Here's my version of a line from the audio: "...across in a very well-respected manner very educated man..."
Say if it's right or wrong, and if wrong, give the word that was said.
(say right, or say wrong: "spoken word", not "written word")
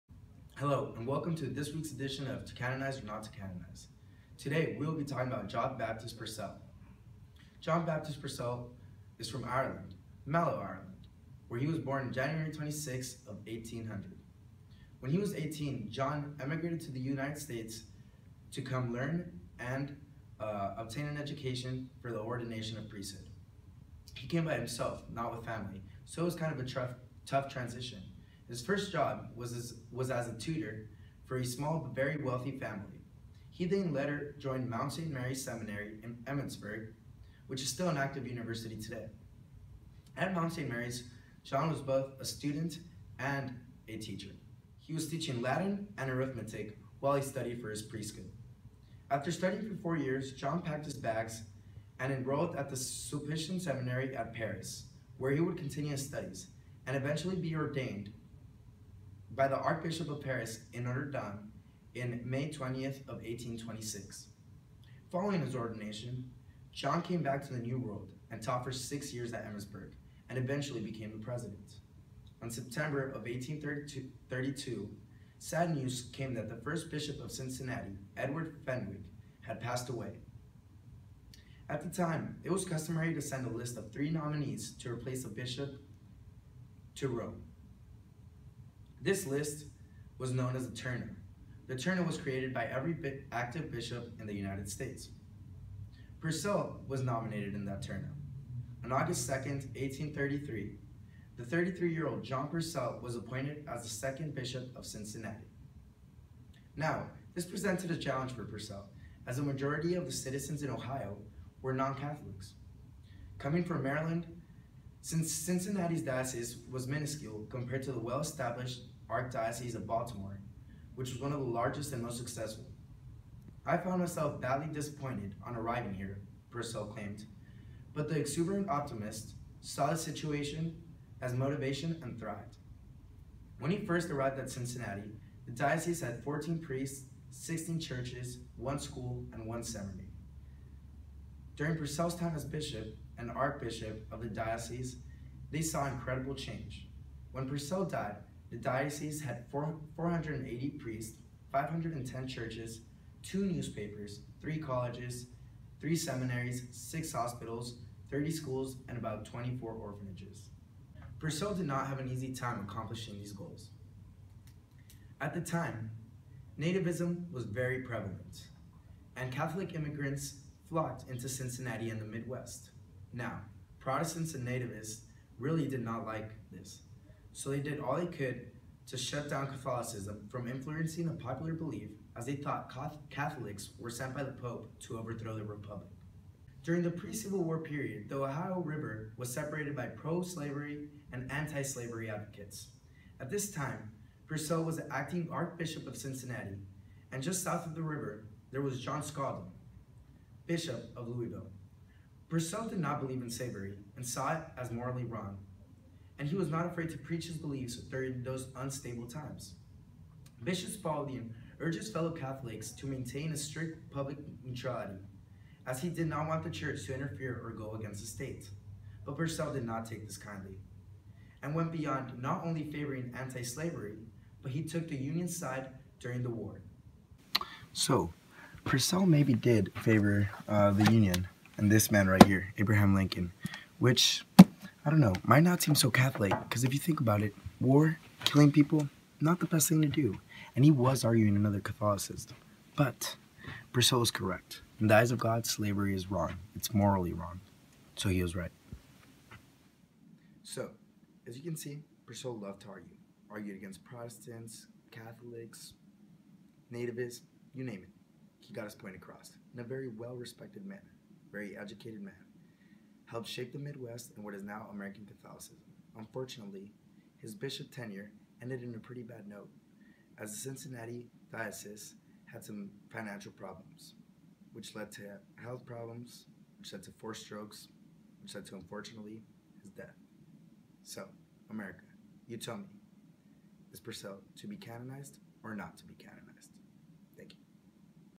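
right.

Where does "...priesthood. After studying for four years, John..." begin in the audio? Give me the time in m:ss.
0:47.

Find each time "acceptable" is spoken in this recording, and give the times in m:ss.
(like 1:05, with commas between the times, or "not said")
not said.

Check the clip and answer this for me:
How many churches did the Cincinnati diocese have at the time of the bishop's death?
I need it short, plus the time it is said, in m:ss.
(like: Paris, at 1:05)
510, at 2:31.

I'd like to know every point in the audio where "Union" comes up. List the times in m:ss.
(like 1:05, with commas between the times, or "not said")
3:44, 3:50.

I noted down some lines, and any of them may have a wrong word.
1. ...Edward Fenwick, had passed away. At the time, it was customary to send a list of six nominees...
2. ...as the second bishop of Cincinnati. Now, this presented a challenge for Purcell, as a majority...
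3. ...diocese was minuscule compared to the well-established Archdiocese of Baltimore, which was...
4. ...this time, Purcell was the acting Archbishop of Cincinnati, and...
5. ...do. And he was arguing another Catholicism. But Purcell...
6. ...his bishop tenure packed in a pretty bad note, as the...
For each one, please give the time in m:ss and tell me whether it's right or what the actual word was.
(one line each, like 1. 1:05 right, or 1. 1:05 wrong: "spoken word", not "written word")
1. 1:18 wrong: "three", not "six"
2. 1:43 right
3. 1:56 right
4. 3:13 right
5. 3:59 right
6. 4:27 wrong: "ended", not "packed".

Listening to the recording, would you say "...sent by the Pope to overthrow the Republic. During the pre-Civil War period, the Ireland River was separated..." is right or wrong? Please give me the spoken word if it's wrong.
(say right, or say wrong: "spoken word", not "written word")
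wrong: "Ohio", not "Ireland".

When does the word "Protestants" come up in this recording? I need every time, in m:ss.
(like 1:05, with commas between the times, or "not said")
2:53, 4:13.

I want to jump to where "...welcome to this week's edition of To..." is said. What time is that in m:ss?
0:01.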